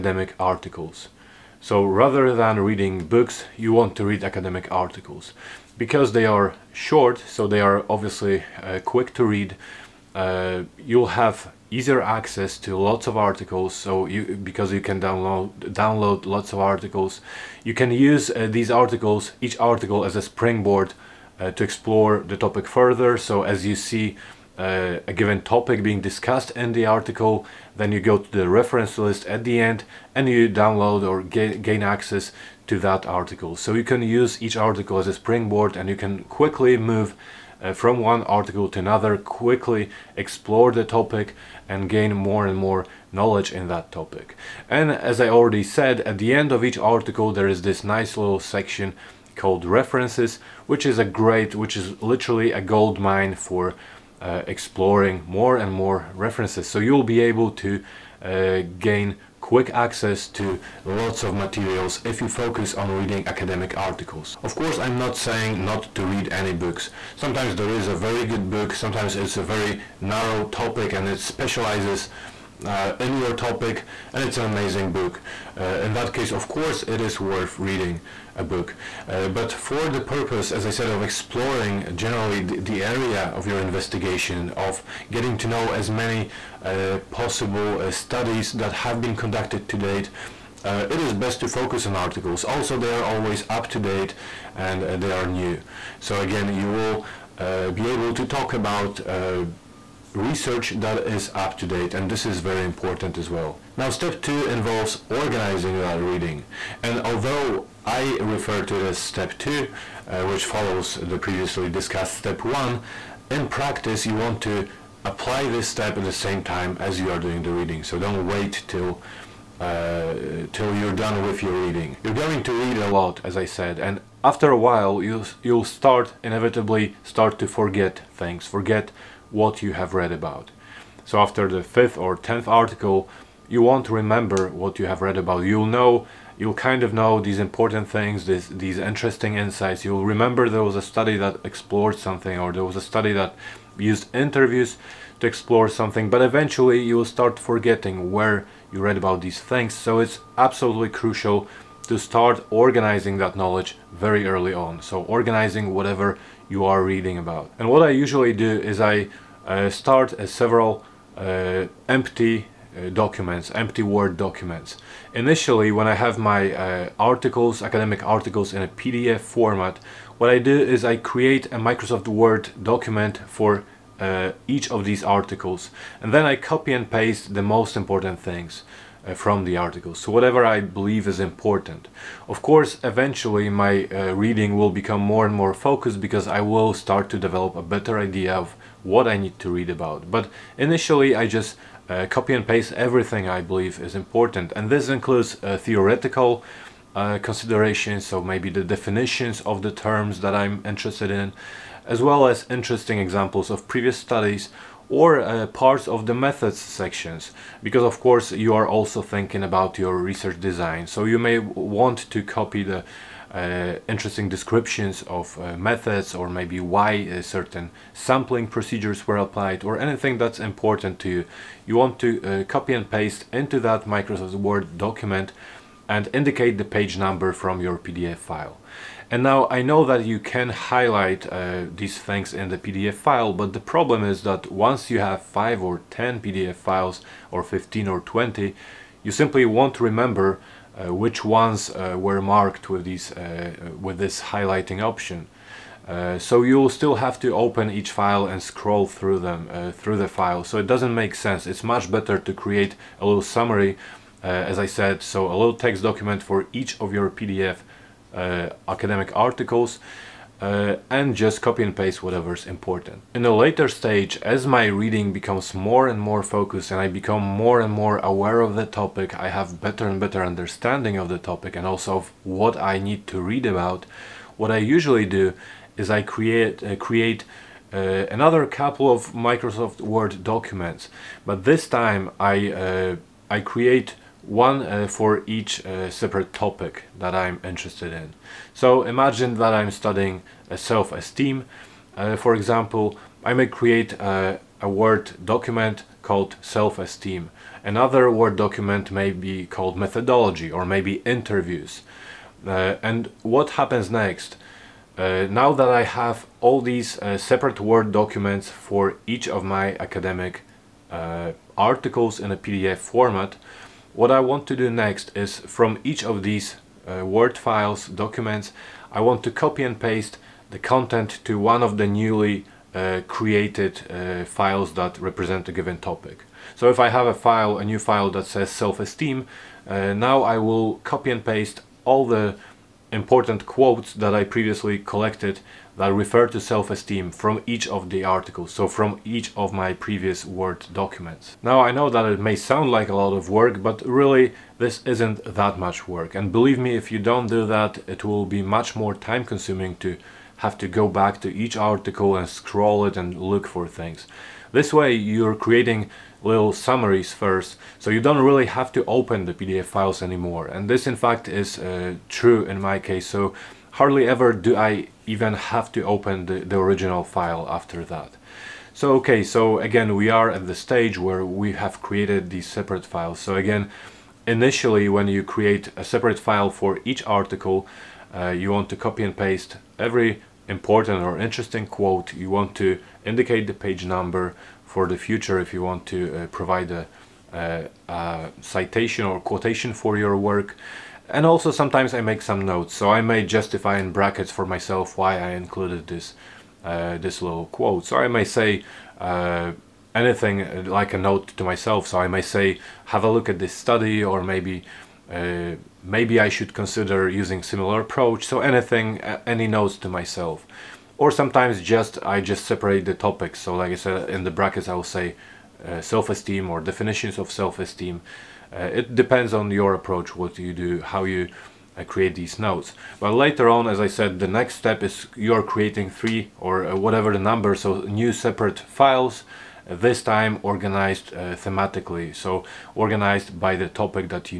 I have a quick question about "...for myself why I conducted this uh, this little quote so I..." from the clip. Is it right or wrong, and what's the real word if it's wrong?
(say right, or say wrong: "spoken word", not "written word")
wrong: "included", not "conducted".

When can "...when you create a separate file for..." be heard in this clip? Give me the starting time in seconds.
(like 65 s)
374 s.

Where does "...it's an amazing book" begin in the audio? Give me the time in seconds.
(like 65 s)
74 s.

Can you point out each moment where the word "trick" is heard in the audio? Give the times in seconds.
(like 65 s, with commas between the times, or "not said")
not said.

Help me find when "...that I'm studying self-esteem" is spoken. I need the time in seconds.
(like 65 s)
289 s.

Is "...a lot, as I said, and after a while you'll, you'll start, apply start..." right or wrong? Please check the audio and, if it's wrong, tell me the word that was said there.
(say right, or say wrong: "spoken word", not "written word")
wrong: "inevitably", not "apply".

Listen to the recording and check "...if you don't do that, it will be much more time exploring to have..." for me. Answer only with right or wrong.
wrong.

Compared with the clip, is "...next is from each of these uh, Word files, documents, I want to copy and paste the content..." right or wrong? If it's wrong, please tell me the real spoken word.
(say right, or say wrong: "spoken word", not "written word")
right.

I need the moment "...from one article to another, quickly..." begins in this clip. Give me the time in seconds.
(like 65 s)
37 s.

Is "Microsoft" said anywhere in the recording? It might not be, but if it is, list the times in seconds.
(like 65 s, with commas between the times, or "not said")
171 s, 223 s, 279 s.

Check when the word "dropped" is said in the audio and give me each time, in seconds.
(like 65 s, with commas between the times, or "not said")
not said.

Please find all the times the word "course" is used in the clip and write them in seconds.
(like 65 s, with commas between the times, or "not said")
64 s, 76 s, 182 s, 208 s.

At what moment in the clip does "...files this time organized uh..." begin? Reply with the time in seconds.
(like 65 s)
428 s.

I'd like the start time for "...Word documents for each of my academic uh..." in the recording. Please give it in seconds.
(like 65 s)
307 s.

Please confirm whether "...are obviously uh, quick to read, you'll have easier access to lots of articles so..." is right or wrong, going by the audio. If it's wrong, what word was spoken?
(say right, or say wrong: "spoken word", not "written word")
right.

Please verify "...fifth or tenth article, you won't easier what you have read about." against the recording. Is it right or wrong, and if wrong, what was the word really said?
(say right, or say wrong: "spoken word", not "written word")
wrong: "remember", not "easier".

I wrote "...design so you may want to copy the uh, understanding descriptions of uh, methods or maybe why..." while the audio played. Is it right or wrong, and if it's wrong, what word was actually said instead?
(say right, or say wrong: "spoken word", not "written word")
wrong: "interesting", not "understanding".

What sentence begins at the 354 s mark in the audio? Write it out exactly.
This way you're creating little summaries first, so you don't really have to open the PDF files anymore.